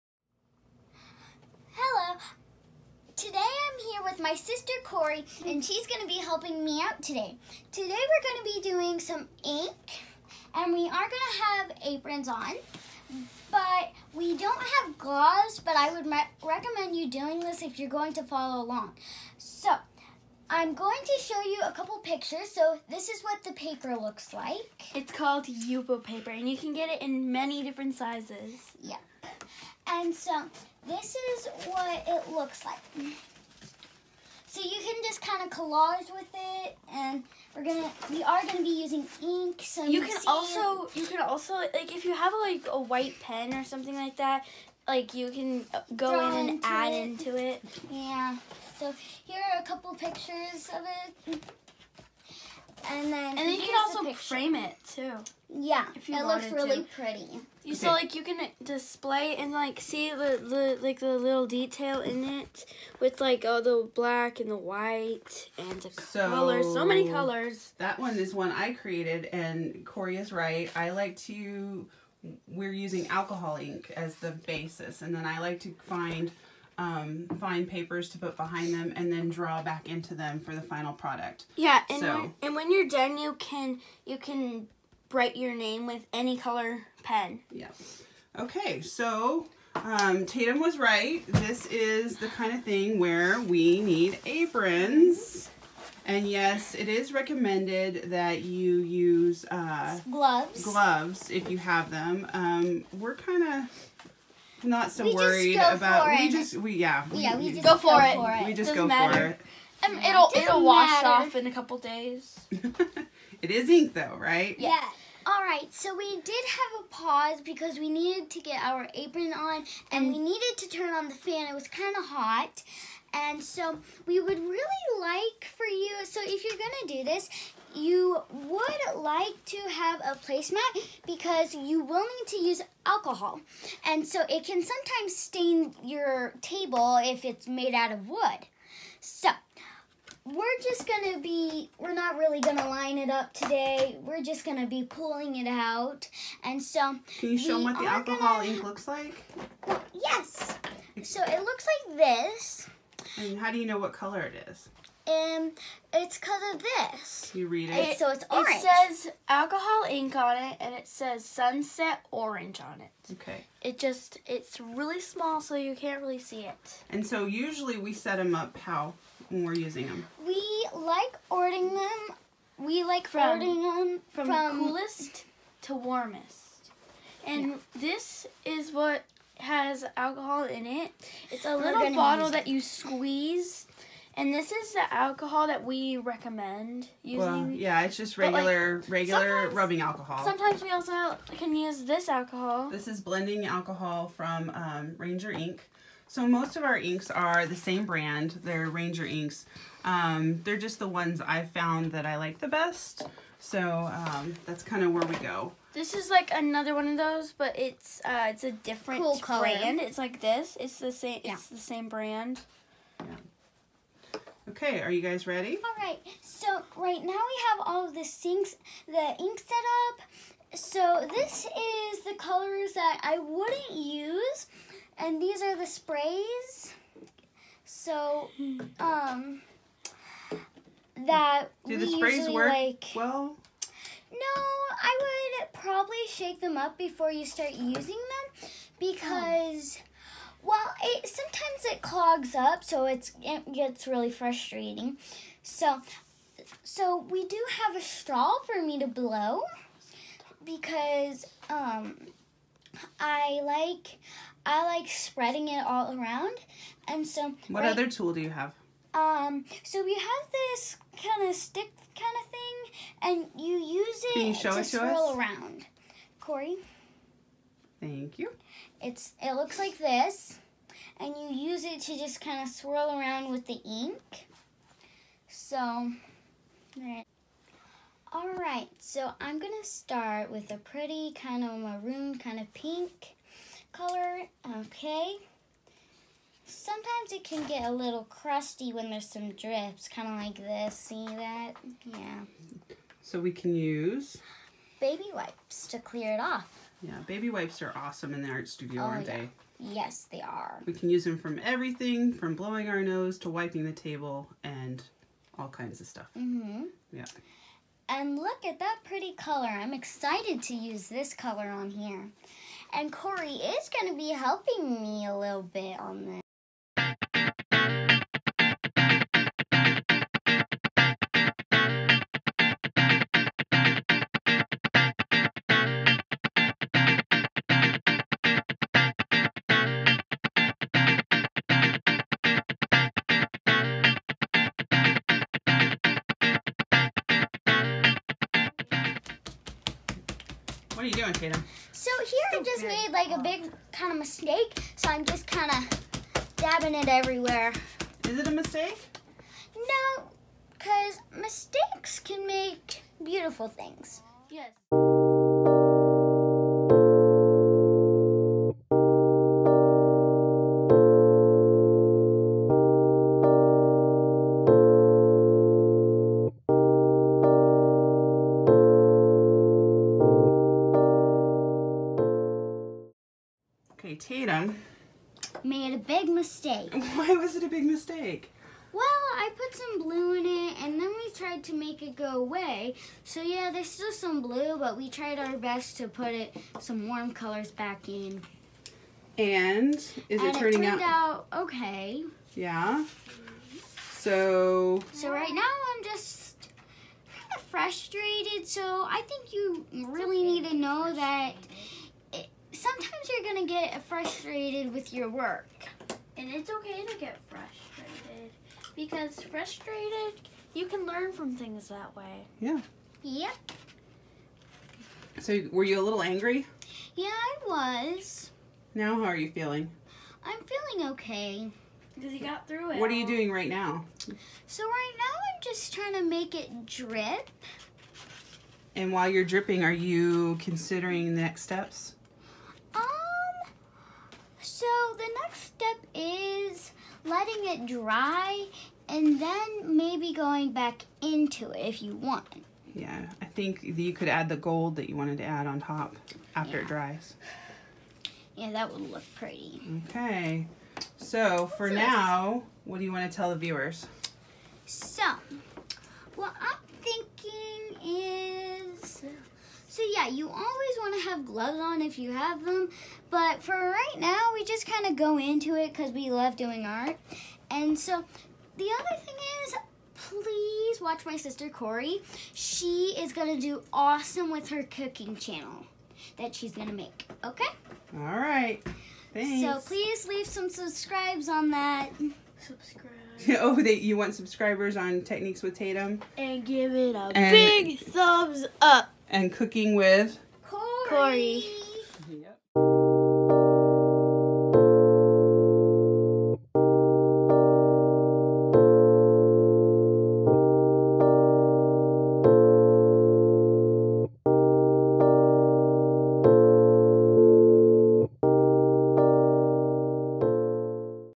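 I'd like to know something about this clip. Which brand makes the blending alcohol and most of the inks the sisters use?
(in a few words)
Ranger Ink.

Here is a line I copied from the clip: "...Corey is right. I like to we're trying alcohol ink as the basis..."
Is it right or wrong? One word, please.
wrong.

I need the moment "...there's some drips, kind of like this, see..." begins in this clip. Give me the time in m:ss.
4:48.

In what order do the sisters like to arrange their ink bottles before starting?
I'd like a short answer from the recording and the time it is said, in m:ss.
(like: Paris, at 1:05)
coolest to warmest, at 2:54.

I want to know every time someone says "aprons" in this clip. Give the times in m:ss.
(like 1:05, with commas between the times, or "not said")
0:11, 1:34, 1:58.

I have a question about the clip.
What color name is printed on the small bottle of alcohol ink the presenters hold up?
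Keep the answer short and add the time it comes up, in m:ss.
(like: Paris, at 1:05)
sunset orange, at 2:41.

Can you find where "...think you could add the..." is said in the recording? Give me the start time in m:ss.
7:23.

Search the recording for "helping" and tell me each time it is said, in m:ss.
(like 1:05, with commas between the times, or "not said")
0:06, 5:14.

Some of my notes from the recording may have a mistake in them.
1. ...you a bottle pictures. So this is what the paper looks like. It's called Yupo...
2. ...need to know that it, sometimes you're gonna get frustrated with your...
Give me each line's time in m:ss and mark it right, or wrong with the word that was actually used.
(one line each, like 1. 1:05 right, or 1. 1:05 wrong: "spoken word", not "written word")
1. 0:21 wrong: "couple", not "bottle"
2. 6:40 right.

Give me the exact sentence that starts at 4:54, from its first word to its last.
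Baby wipes to clear it off.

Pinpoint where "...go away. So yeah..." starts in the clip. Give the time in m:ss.
6:21.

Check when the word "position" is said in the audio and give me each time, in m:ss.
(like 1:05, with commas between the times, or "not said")
not said.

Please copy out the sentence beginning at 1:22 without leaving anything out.
when, and when you're done, you can you can write your name with any color pen.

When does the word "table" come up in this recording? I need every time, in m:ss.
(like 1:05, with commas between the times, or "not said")
2:16, 5:03.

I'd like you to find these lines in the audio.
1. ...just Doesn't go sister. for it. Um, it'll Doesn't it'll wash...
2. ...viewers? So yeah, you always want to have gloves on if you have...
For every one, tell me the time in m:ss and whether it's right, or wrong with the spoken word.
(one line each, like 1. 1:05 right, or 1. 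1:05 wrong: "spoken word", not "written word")
1. 1:48 wrong: "matter", not "sister"
2. 7:33 right.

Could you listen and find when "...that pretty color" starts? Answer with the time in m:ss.
5:08.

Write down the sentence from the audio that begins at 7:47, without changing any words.
And so the other thing is, please watch my sister Corey.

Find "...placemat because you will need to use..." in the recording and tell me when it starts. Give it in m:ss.
2:10.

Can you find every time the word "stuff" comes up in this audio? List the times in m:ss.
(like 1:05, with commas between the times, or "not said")
5:05.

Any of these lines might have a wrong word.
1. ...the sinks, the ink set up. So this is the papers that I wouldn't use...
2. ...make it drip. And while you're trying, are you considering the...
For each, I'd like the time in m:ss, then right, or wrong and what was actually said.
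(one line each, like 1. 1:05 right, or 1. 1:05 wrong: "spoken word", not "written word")
1. 3:37 wrong: "colors", not "papers"
2. 7:06 wrong: "dripping", not "trying".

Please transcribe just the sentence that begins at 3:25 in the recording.
This is like another one of those, but it's uh, it's a different cool brand.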